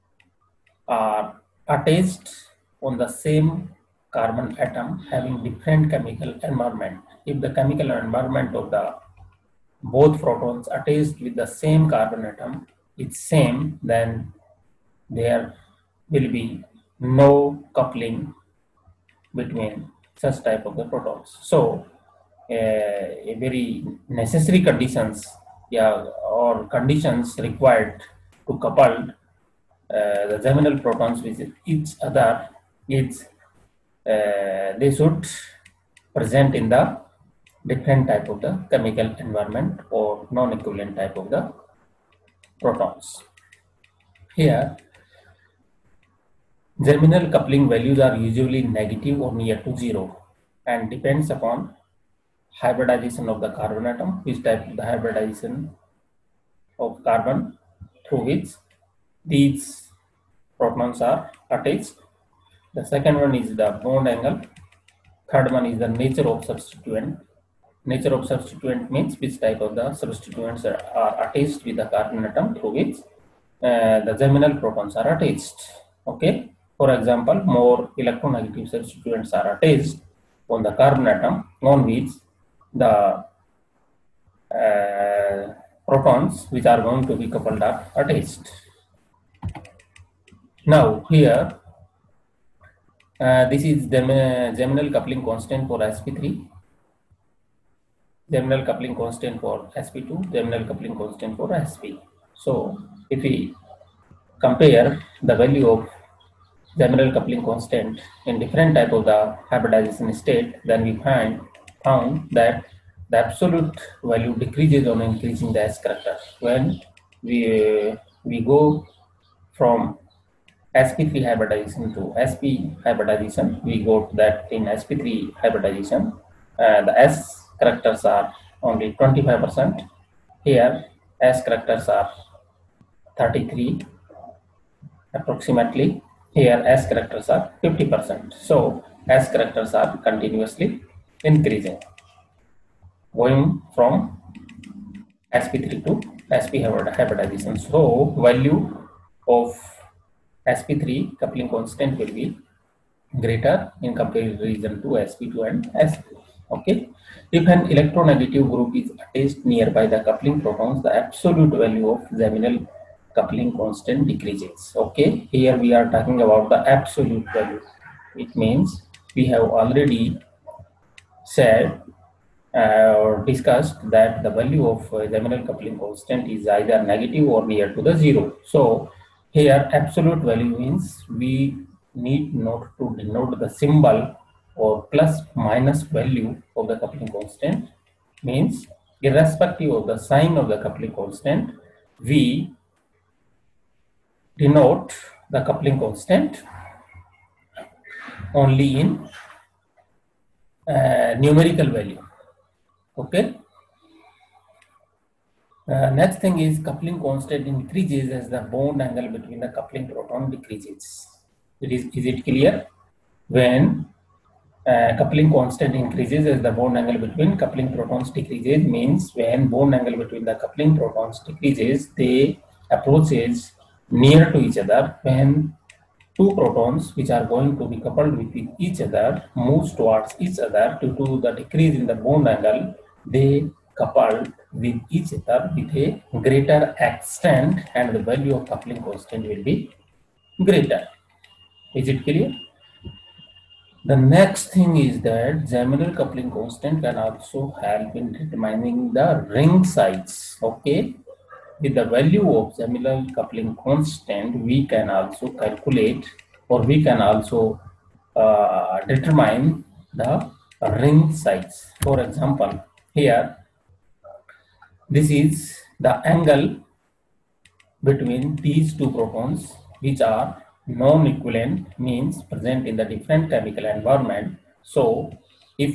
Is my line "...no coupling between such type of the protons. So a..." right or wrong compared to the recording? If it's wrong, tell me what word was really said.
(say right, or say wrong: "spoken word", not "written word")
right.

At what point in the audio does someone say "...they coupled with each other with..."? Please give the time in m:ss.
3:53.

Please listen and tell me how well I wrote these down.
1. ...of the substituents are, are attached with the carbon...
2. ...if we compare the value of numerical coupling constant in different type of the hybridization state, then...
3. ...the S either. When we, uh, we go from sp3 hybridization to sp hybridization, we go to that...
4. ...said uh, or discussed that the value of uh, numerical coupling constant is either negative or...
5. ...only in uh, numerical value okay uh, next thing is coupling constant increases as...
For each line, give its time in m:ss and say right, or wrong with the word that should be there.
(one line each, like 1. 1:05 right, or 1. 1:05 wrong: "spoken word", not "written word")
1. 1:09 right
2. 1:43 wrong: "geminal", not "numerical"
3. 1:55 wrong: "character", not "either"
4. 2:51 wrong: "geminal", not "numerical"
5. 3:18 right.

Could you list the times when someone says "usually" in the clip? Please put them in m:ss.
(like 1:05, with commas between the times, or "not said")
0:48.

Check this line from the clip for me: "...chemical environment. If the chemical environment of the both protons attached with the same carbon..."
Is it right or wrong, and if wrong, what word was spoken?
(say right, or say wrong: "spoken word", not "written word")
right.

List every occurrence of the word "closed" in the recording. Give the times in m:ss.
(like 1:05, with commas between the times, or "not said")
not said.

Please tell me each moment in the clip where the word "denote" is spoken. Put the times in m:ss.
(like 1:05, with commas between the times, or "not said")
3:02, 3:14.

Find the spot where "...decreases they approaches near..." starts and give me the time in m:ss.
3:41.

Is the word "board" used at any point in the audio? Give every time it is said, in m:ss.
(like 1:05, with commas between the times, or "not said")
not said.